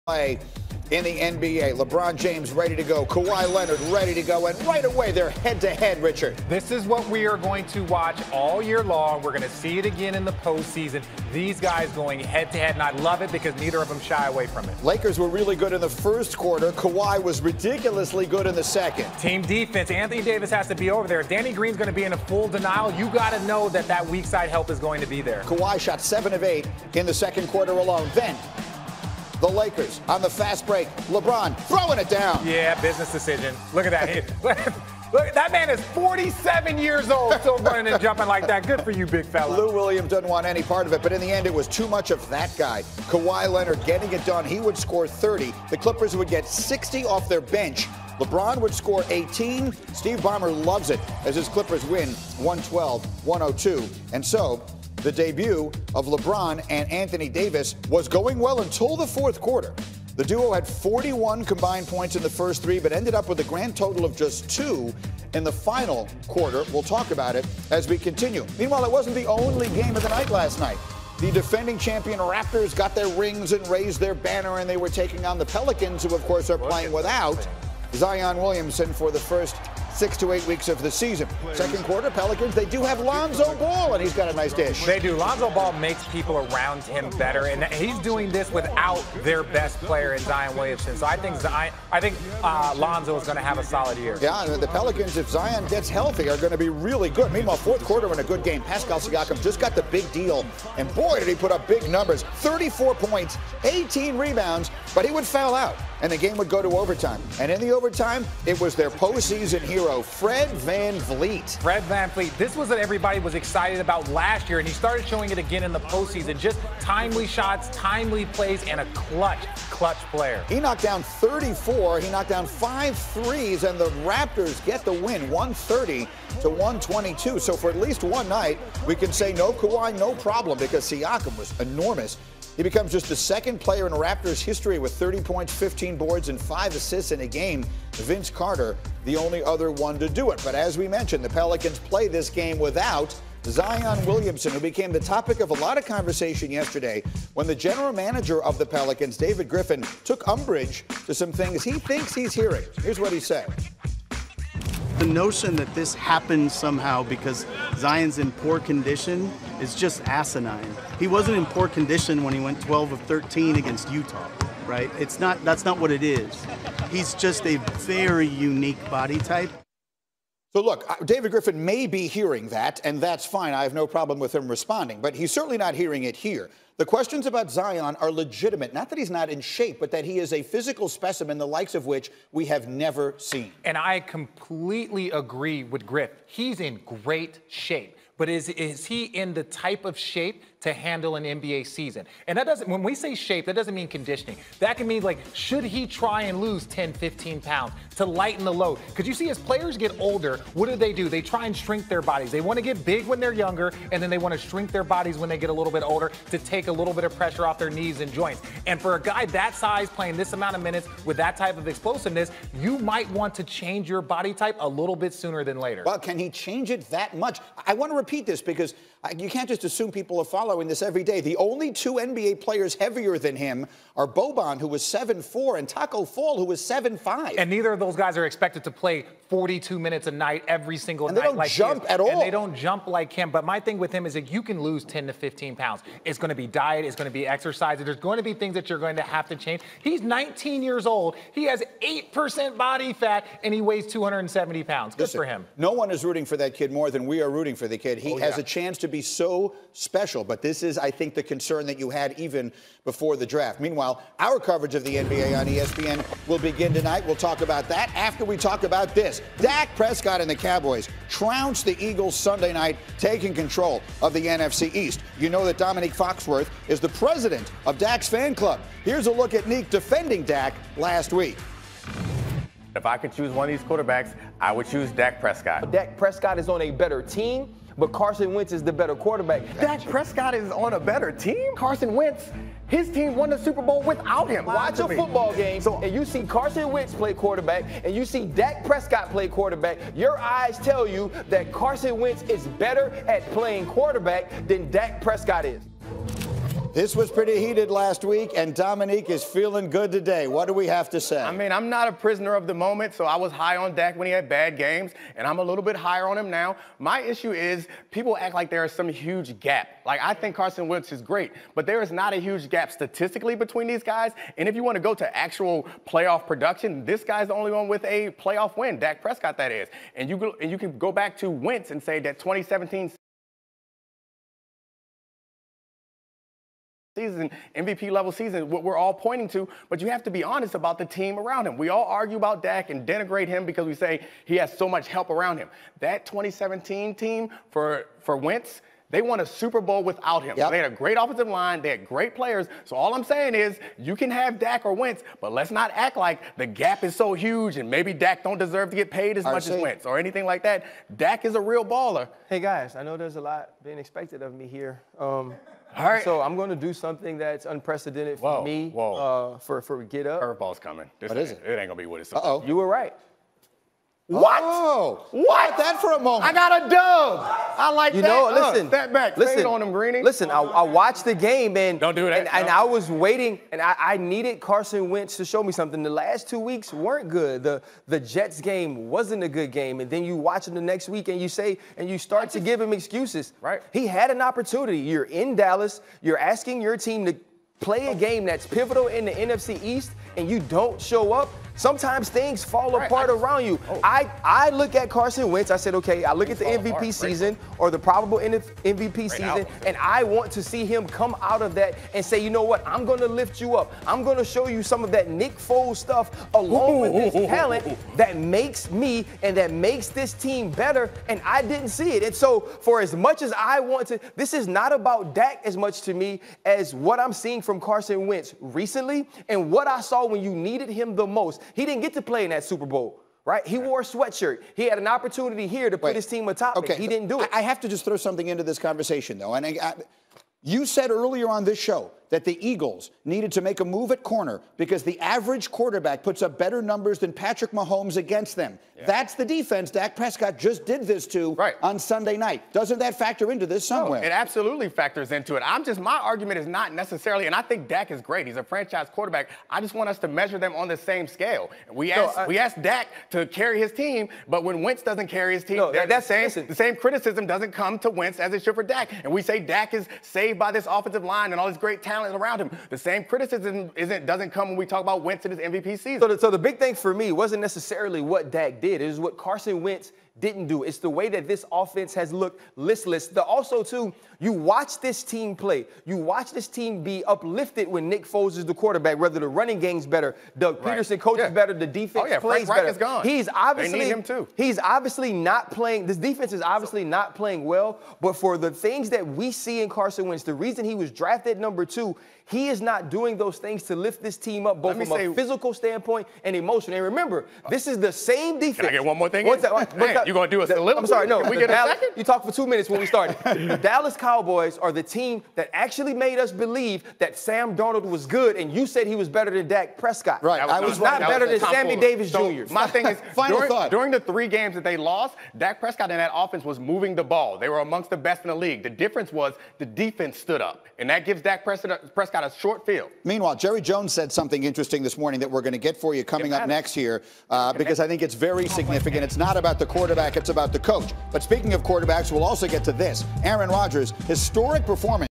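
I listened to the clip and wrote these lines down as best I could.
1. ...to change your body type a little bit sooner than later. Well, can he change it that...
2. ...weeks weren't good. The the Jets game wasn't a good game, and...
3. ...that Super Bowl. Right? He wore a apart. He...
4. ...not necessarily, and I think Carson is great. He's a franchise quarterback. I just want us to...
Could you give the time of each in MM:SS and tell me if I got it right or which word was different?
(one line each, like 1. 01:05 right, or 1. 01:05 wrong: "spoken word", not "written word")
1. 03:33 right
2. 06:16 right
3. 07:02 wrong: "sweatshirt", not "apart"
4. 07:26 wrong: "Dak", not "Carson".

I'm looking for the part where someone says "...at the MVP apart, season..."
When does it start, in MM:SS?
06:36.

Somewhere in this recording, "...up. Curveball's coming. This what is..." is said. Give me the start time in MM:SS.
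06:00.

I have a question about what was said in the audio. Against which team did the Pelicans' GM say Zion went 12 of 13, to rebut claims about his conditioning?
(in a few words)
Utah.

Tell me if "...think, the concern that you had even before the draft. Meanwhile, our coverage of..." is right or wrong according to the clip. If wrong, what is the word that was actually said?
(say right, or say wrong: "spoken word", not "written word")
right.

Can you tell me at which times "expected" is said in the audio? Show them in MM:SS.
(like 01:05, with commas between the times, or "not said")
03:48, 05:53.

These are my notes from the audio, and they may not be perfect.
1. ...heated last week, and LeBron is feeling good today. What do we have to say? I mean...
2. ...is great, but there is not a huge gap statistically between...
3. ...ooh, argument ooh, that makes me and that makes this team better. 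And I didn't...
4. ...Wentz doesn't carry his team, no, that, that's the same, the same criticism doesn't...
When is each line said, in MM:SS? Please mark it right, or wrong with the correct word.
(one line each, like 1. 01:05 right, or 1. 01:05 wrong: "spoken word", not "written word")
1. 04:57 wrong: "Dominique", not "LeBron"
2. 05:10 right
3. 06:47 wrong: "talent", not "argument"
4. 07:34 right.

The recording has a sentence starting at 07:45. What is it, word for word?
So the, so the big thing for me wasn't necessarily what Dak did.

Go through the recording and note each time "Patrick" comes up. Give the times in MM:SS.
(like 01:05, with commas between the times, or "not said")
07:17.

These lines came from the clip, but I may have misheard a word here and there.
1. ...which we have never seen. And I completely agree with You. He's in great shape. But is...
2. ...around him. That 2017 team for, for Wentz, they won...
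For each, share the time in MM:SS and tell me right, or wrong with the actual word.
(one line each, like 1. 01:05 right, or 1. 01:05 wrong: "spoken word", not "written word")
1. 03:01 wrong: "Griff", not "You"
2. 05:35 right.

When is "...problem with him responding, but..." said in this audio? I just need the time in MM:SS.
02:53.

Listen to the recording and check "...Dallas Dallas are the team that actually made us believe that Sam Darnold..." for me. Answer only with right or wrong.
wrong.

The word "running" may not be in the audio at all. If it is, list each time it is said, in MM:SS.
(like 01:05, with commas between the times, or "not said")
00:37, 07:59.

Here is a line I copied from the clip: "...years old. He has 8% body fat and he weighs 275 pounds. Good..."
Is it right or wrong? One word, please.
wrong.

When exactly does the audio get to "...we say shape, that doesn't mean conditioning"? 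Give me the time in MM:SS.
03:12.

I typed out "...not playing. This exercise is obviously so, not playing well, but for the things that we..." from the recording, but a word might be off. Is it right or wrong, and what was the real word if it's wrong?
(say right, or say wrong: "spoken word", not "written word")
wrong: "defense", not "exercise".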